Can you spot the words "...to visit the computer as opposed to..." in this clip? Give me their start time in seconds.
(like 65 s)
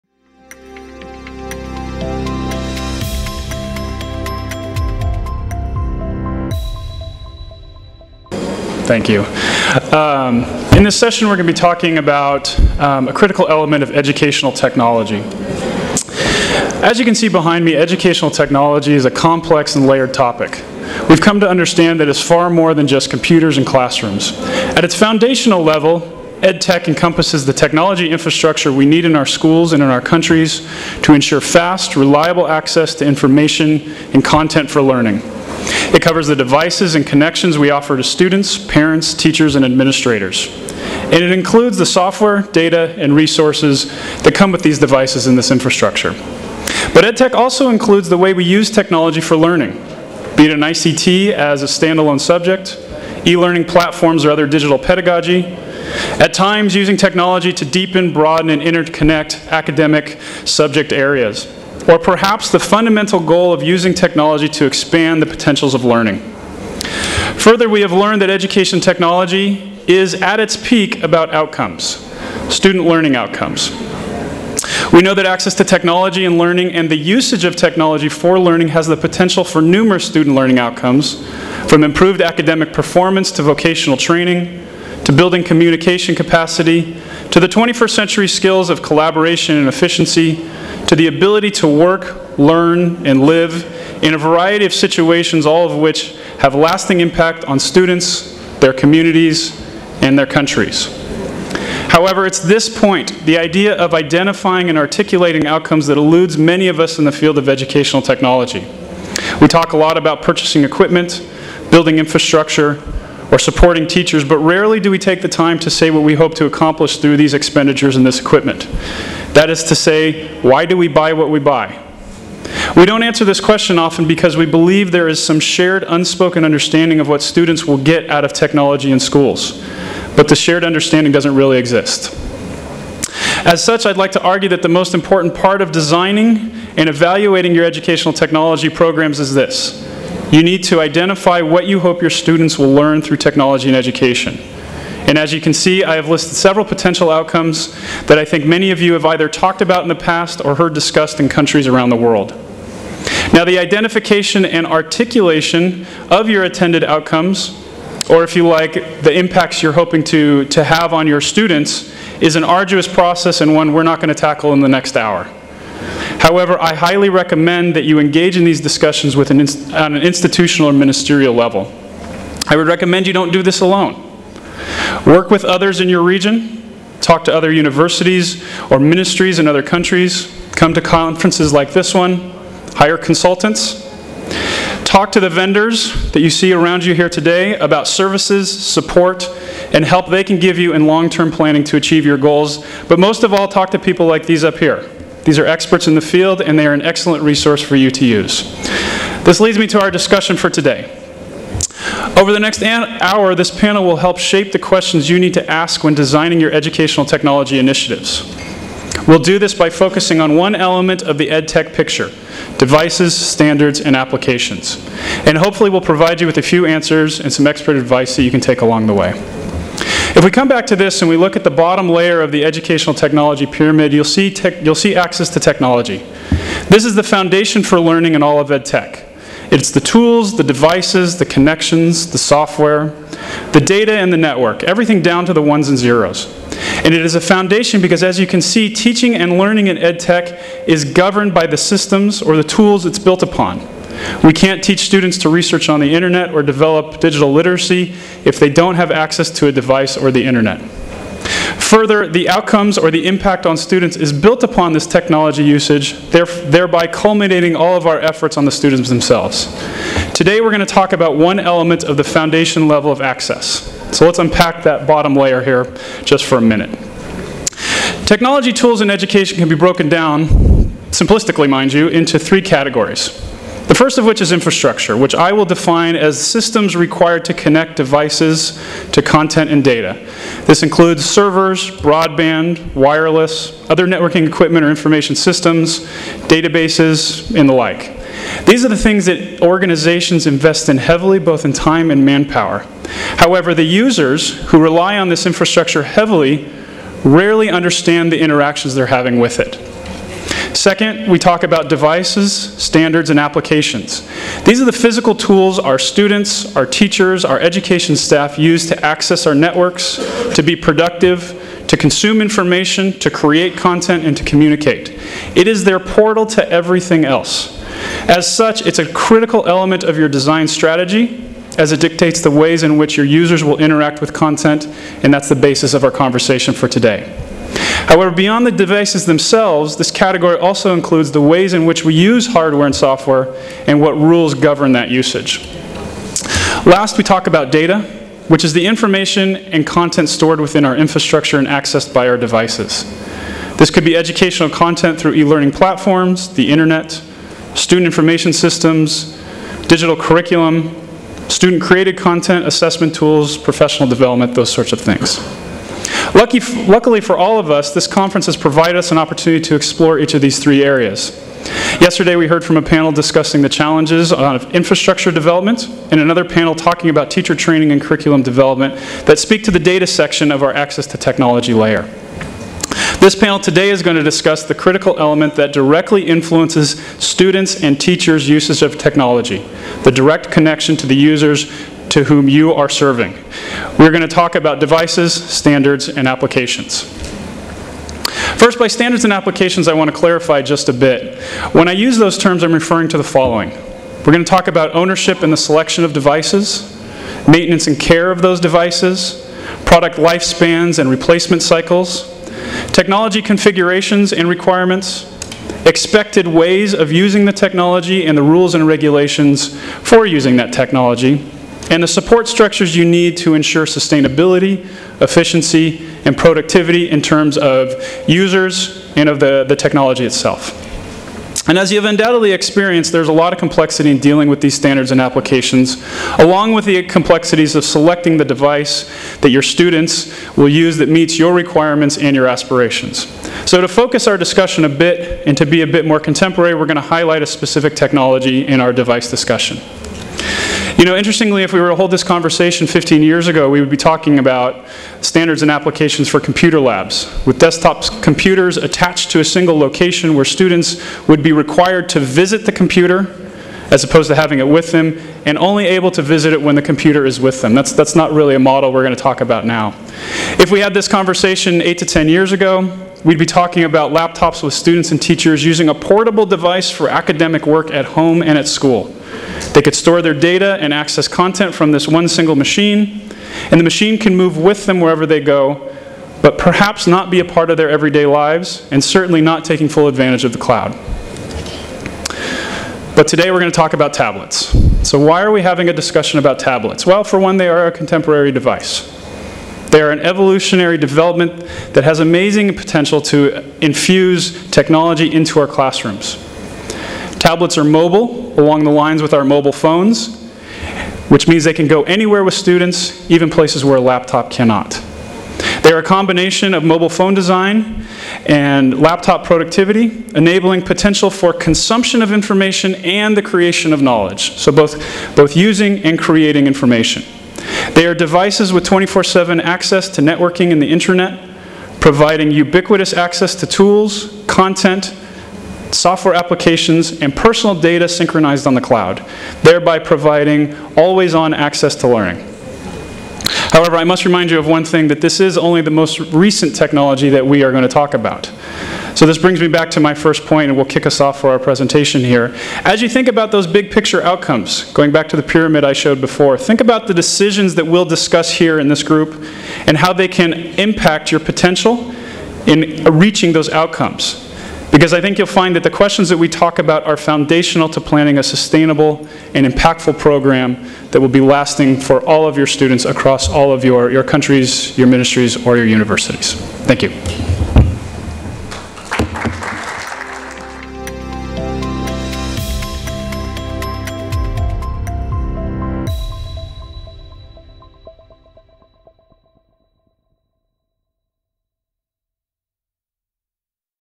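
451 s.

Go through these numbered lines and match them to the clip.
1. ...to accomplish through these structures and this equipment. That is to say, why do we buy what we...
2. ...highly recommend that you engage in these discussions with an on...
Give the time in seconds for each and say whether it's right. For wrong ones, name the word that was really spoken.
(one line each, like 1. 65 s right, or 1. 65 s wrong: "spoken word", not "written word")
1. 116 s wrong: "expenditures", not "structures"
2. 166 s right.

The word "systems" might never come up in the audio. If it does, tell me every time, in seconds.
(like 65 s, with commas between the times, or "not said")
241 s, 276 s, 285 s, 348 s.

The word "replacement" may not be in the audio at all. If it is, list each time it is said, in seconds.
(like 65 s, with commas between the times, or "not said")
400 s.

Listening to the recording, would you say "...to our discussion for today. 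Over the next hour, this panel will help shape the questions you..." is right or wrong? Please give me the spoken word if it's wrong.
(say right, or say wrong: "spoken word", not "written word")
right.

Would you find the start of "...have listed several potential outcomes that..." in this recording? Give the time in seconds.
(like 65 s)
145 s.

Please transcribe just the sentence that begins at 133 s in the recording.
As such, I'd like to argue that the most important part of designing and evaluating your educational technology programs is this.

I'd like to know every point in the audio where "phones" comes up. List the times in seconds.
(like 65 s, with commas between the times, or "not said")
499 s, 506 s.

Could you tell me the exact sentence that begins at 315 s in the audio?
It is their portal to everything else.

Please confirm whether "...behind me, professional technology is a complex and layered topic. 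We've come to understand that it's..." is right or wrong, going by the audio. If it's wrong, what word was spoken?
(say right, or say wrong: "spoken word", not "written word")
wrong: "educational", not "professional".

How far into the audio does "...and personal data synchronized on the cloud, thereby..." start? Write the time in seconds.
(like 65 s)
527 s.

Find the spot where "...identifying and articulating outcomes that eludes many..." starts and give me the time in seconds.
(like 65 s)
103 s.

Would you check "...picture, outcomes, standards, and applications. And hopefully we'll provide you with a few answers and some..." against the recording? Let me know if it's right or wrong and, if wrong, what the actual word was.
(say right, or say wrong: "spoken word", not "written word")
wrong: "devices", not "outcomes".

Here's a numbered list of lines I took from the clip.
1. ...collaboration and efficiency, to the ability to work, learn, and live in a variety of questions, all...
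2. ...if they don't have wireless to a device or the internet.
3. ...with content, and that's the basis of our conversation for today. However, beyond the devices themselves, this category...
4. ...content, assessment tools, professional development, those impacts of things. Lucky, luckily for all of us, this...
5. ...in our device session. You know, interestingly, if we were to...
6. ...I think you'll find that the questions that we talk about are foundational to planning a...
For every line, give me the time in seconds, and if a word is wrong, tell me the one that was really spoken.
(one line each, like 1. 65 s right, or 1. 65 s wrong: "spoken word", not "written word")
1. 88 s wrong: "situations", not "questions"
2. 248 s wrong: "access", not "wireless"
3. 324 s right
4. 351 s wrong: "sorts", not "impacts"
5. 438 s wrong: "discussion", not "session"
6. 554 s right.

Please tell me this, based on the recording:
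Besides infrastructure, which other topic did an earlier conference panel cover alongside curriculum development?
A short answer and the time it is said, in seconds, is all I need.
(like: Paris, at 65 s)
teacher training, at 367 s.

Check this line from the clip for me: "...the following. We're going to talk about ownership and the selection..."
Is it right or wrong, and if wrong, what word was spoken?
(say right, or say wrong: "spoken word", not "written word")
right.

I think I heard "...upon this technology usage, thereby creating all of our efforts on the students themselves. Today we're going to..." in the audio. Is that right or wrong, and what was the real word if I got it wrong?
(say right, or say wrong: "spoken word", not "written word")
wrong: "culminating", not "creating".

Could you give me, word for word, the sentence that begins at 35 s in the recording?
It covers the devices and connections we offer to students, parents, teachers, and administrators.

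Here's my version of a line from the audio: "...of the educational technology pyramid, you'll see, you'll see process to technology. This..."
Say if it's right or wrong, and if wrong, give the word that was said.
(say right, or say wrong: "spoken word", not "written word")
wrong: "access", not "process".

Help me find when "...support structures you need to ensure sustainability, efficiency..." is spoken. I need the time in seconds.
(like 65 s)
411 s.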